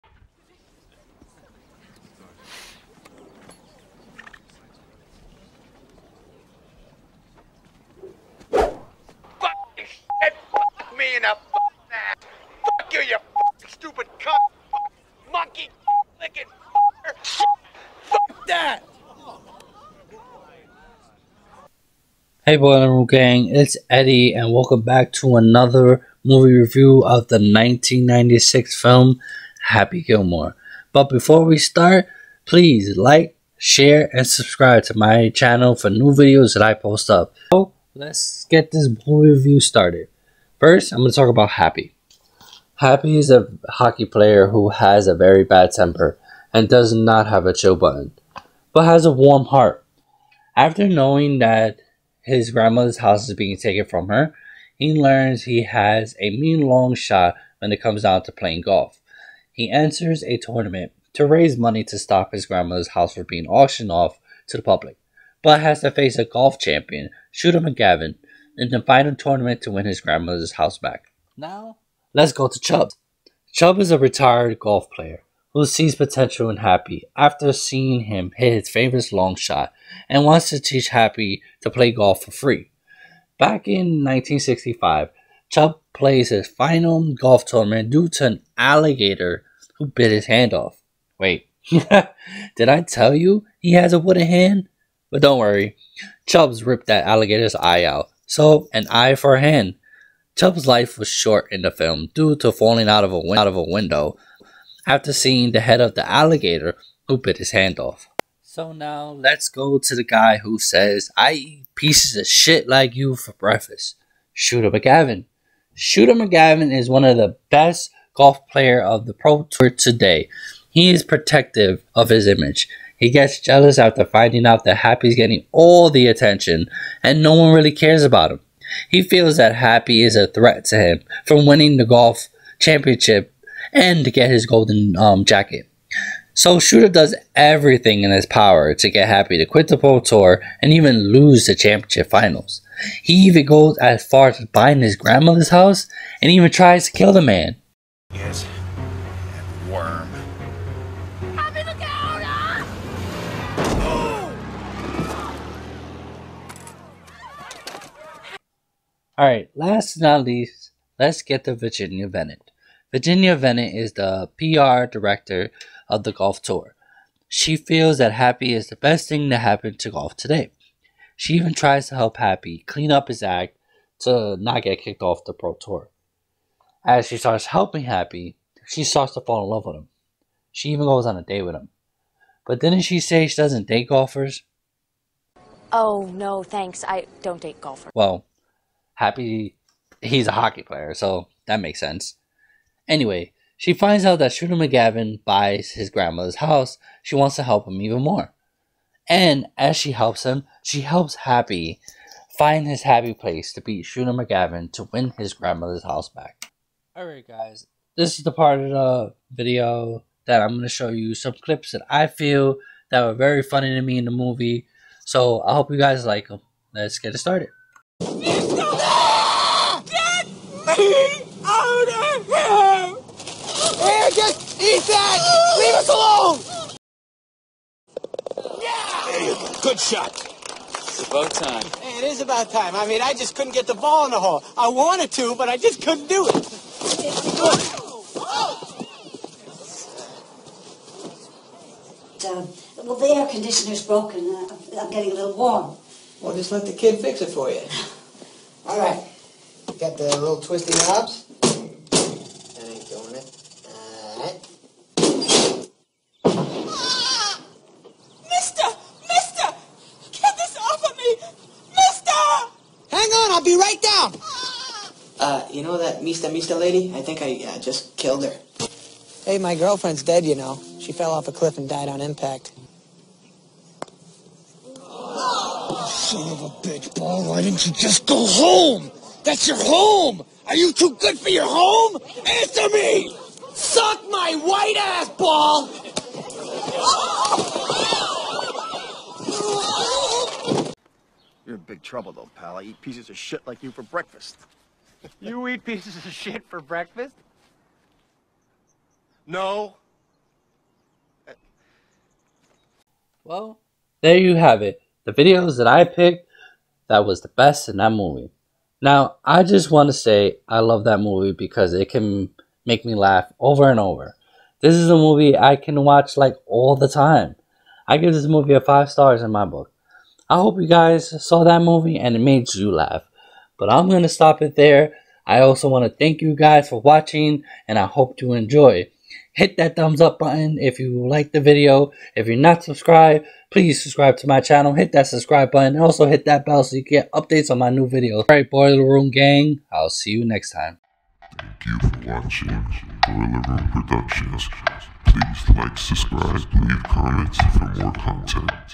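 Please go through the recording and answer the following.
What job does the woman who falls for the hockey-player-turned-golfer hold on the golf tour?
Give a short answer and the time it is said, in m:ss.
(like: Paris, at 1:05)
PR director, at 2:44.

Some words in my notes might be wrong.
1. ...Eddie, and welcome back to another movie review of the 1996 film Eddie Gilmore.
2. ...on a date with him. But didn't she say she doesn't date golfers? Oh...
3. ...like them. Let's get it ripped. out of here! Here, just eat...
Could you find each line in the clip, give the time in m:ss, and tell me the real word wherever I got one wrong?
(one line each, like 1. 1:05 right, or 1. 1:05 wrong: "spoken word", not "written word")
1. 0:23 wrong: "Happy", not "Eddie"
2. 3:01 right
3. 3:36 wrong: "started", not "ripped".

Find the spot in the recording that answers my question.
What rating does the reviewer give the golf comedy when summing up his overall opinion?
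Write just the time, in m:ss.
5:18.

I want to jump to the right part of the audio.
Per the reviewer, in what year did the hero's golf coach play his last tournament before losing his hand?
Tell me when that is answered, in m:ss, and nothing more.
1:24.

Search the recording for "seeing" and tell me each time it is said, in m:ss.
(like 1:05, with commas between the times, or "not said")
1:17, 1:45.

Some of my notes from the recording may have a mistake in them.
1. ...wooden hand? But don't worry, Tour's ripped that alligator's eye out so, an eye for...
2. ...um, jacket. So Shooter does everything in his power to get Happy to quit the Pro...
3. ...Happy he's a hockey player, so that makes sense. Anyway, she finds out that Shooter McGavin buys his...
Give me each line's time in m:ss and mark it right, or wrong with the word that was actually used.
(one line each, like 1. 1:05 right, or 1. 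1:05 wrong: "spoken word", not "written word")
1. 1:33 wrong: "Chubb", not "Tour"
2. 2:14 right
3. 3:09 right.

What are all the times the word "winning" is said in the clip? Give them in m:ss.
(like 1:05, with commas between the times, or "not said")
2:11.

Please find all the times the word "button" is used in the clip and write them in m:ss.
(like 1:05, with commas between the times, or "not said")
0:47, 5:30, 5:35.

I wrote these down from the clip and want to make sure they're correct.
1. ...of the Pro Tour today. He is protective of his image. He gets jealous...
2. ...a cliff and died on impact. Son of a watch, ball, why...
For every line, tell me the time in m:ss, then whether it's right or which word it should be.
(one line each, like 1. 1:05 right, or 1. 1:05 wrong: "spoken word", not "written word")
1. 1:58 right
2. 4:31 wrong: "bitch", not "watch".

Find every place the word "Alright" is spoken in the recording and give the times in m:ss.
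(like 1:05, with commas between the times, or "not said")
3:26, 4:14, 5:38.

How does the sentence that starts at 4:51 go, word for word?
You're in big trouble, though, pal.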